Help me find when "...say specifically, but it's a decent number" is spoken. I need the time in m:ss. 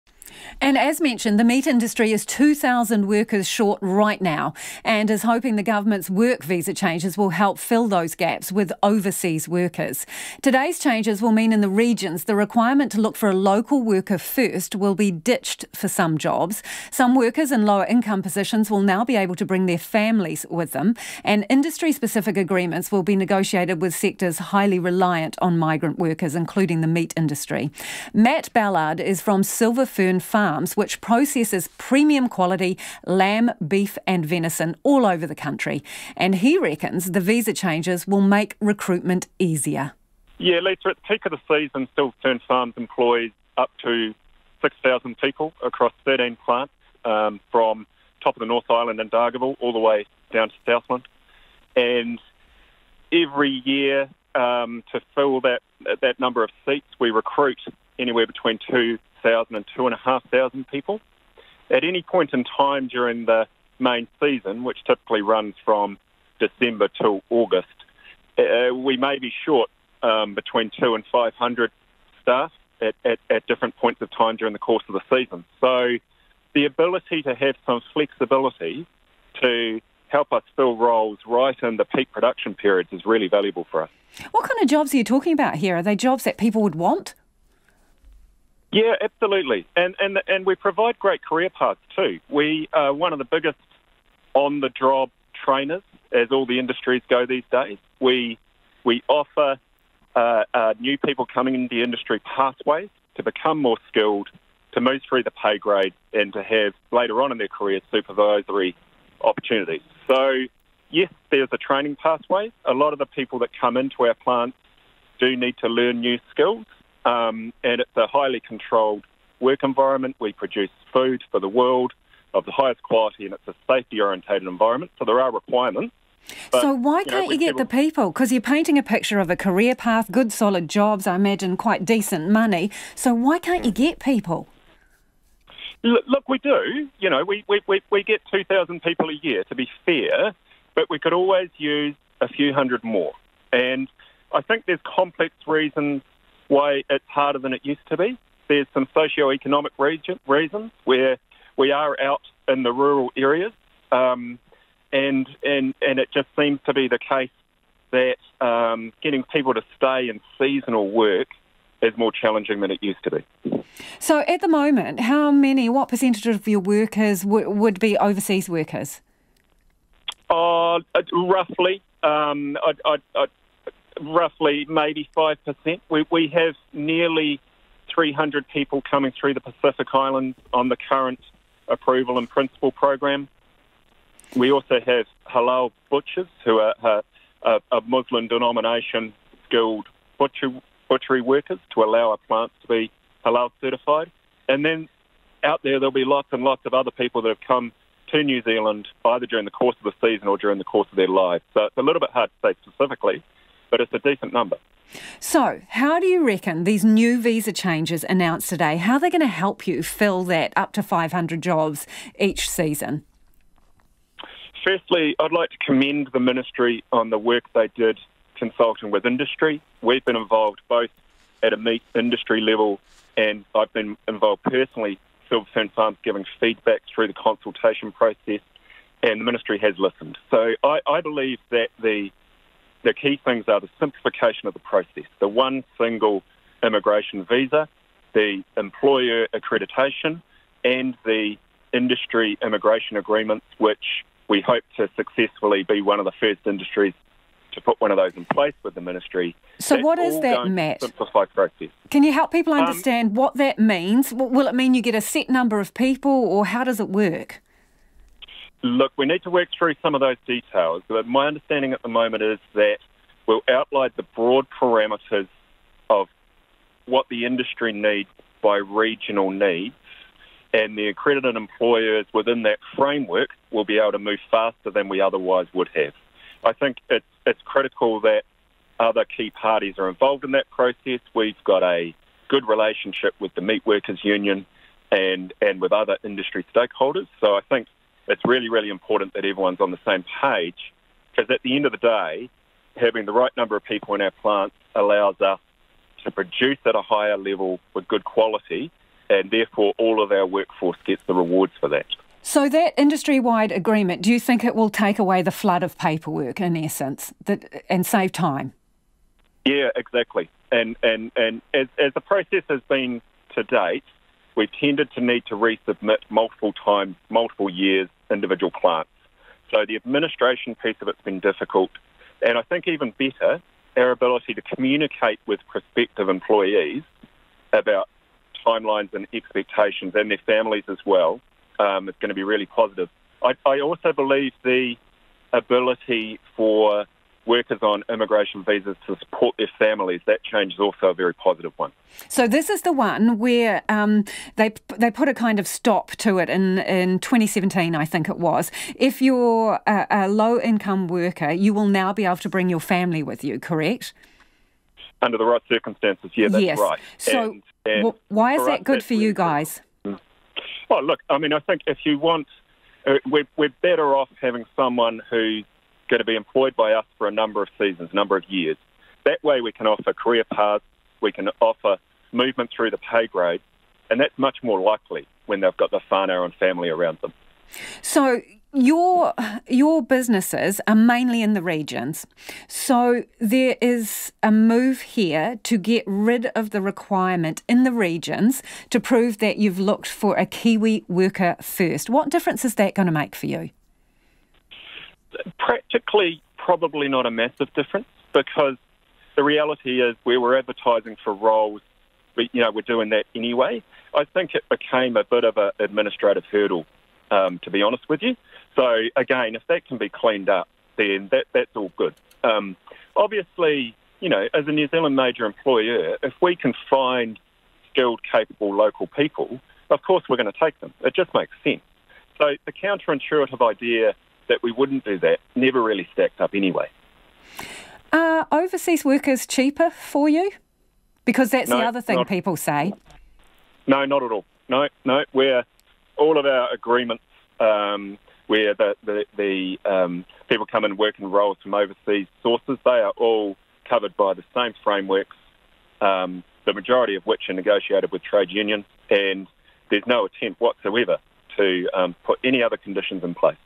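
3:22.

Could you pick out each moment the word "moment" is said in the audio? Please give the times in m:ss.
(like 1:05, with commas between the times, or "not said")
2:44, 4:21.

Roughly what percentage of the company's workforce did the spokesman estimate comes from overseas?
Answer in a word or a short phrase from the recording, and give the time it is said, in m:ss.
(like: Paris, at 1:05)
5%, at 2:55.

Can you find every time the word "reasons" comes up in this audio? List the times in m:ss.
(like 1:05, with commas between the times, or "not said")
2:25, 2:30.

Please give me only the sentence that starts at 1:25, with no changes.
Are they jobs that people would want?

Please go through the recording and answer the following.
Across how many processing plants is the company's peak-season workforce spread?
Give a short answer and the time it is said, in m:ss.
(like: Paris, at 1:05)
13, at 0:46.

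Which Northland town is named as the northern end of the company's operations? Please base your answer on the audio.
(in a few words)
Dargaville.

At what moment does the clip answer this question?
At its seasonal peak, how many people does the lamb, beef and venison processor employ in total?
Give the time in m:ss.
0:44.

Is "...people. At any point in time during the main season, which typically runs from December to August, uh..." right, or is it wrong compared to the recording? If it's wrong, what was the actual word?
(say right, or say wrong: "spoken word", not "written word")
right.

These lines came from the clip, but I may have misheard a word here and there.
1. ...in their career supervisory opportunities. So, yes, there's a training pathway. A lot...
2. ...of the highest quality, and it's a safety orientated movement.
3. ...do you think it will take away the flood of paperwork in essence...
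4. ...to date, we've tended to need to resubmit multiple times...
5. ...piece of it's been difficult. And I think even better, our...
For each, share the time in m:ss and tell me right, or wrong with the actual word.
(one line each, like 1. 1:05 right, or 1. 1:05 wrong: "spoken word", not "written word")
1. 1:47 right
2. 2:02 wrong: "environment", not "movement"
3. 5:04 right
4. 5:13 right
5. 5:20 right.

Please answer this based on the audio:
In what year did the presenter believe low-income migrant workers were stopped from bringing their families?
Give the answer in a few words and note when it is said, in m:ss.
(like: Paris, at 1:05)
2017, at 5:46.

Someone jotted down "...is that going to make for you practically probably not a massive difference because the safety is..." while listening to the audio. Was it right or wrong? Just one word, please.
wrong.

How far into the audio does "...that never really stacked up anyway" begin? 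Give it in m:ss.
7:04.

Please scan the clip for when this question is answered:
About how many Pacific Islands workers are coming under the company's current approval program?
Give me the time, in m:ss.
2:57.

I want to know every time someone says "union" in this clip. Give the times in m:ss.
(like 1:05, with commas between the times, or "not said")
4:44, 7:28.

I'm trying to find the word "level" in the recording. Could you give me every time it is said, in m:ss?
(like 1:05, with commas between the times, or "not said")
3:42, 4:57.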